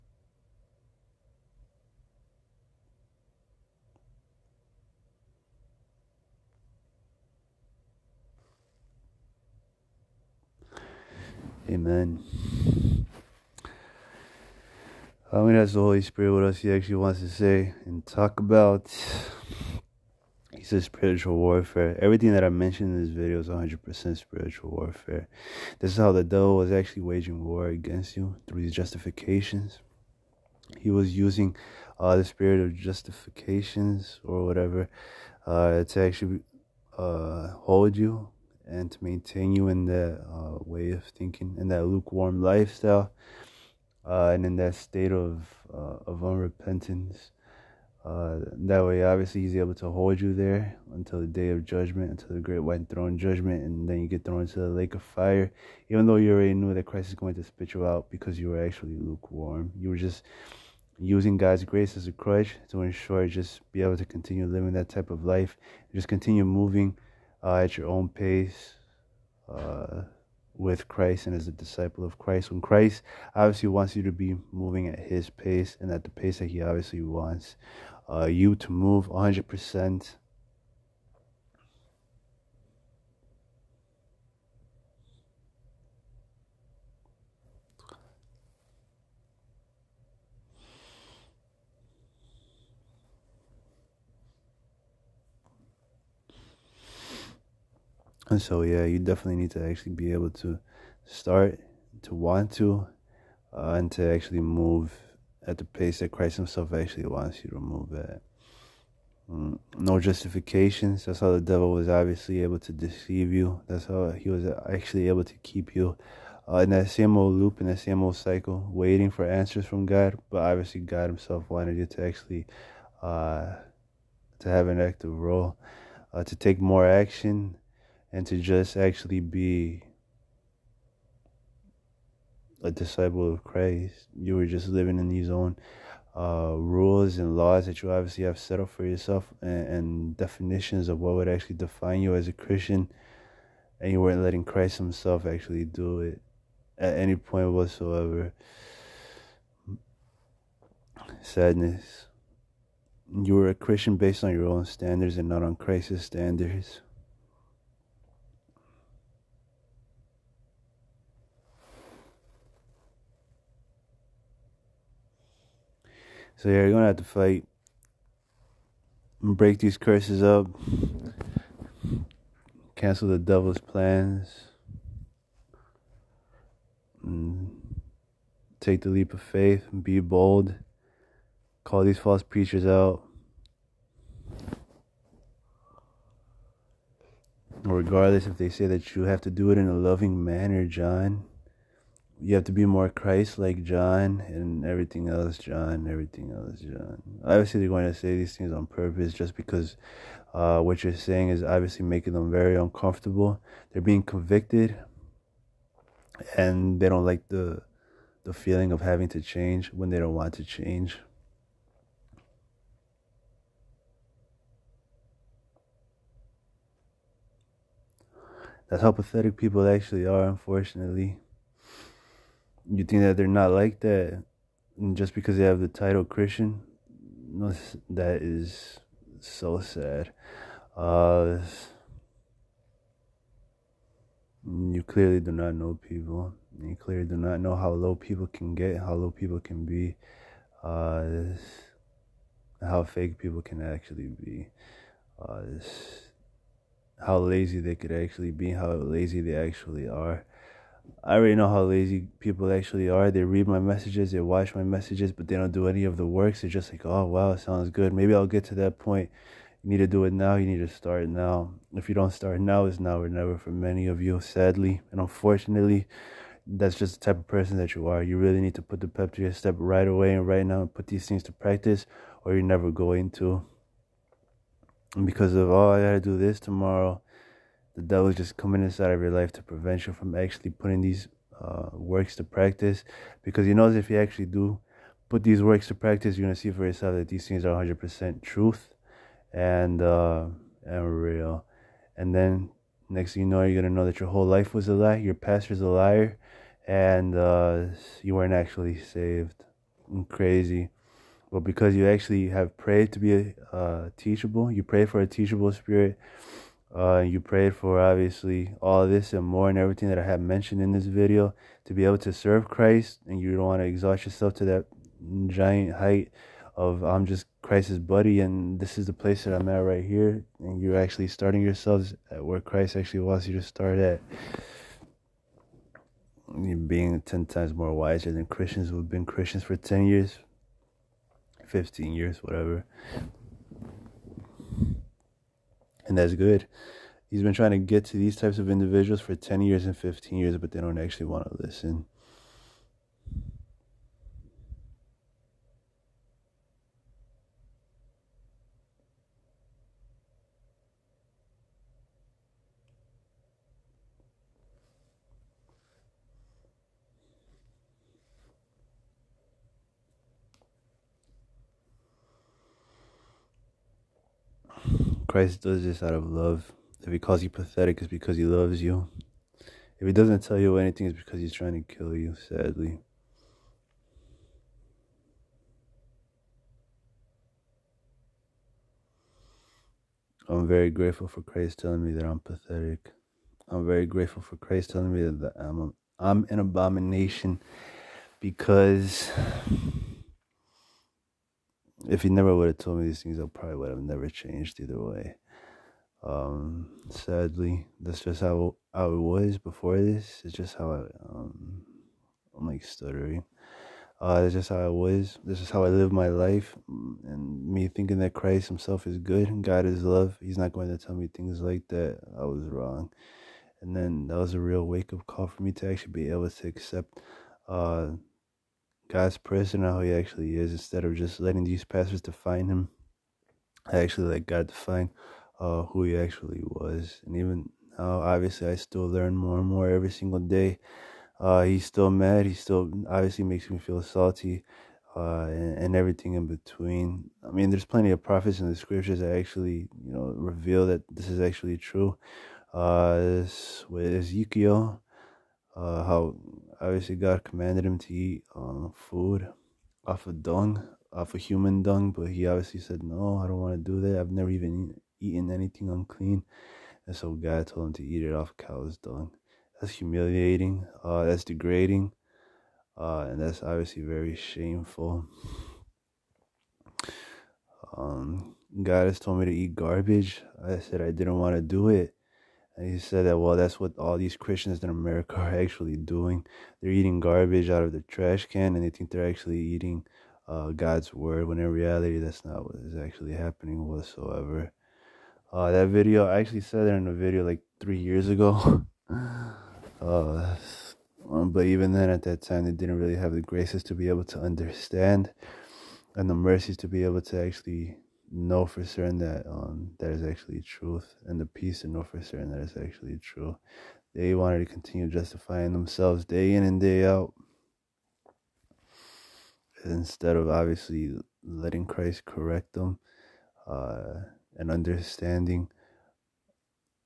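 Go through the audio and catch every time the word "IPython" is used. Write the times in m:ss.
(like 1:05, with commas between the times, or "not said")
not said.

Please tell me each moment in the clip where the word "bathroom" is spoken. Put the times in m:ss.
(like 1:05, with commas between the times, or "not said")
not said.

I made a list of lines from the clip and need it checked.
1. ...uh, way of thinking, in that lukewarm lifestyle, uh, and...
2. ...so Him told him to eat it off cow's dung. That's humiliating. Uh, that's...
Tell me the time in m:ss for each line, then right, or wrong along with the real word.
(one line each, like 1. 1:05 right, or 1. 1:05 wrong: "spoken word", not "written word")
1. 0:40 right
2. 7:36 wrong: "God", not "Him".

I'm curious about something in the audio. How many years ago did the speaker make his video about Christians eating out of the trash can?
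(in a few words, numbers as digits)
3.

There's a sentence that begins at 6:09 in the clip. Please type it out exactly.
If he doesn't tell you anything, it's because he's trying to kill you, sadly.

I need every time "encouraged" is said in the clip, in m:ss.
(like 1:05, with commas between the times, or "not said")
not said.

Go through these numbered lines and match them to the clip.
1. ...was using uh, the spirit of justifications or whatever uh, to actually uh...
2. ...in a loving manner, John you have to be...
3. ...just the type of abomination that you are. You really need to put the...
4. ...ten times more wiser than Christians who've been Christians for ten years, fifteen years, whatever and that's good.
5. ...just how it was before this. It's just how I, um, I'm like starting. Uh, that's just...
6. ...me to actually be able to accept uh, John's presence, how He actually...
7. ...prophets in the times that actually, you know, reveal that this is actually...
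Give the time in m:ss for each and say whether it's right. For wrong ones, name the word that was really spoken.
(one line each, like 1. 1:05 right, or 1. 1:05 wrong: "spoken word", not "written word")
1. 0:30 right
2. 3:09 right
3. 4:26 wrong: "person", not "abomination"
4. 5:27 right
5. 6:38 wrong: "stuttering", not "starting"
6. 6:55 wrong: "God", not "John"
7. 7:18 wrong: "scriptures", not "times".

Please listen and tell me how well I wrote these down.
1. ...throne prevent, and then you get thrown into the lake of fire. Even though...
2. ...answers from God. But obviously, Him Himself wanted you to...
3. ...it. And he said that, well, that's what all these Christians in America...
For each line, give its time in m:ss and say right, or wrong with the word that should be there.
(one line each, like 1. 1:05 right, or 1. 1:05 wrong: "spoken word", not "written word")
1. 0:52 wrong: "judgment", not "prevent"
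2. 1:59 wrong: "God", not "Him"
3. 7:51 right.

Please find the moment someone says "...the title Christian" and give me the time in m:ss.
3:45.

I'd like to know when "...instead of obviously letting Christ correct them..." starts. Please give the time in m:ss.
8:29.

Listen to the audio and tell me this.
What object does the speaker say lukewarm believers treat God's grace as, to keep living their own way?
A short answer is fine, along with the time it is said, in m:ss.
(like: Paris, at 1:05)
a crutch, at 1:02.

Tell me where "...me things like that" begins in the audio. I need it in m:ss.
6:50.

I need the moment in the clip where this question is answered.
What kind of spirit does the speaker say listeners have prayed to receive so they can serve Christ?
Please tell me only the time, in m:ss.
5:05.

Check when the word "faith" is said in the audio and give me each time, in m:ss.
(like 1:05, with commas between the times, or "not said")
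2:59.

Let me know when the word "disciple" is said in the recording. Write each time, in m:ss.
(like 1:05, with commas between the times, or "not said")
1:11, 2:12.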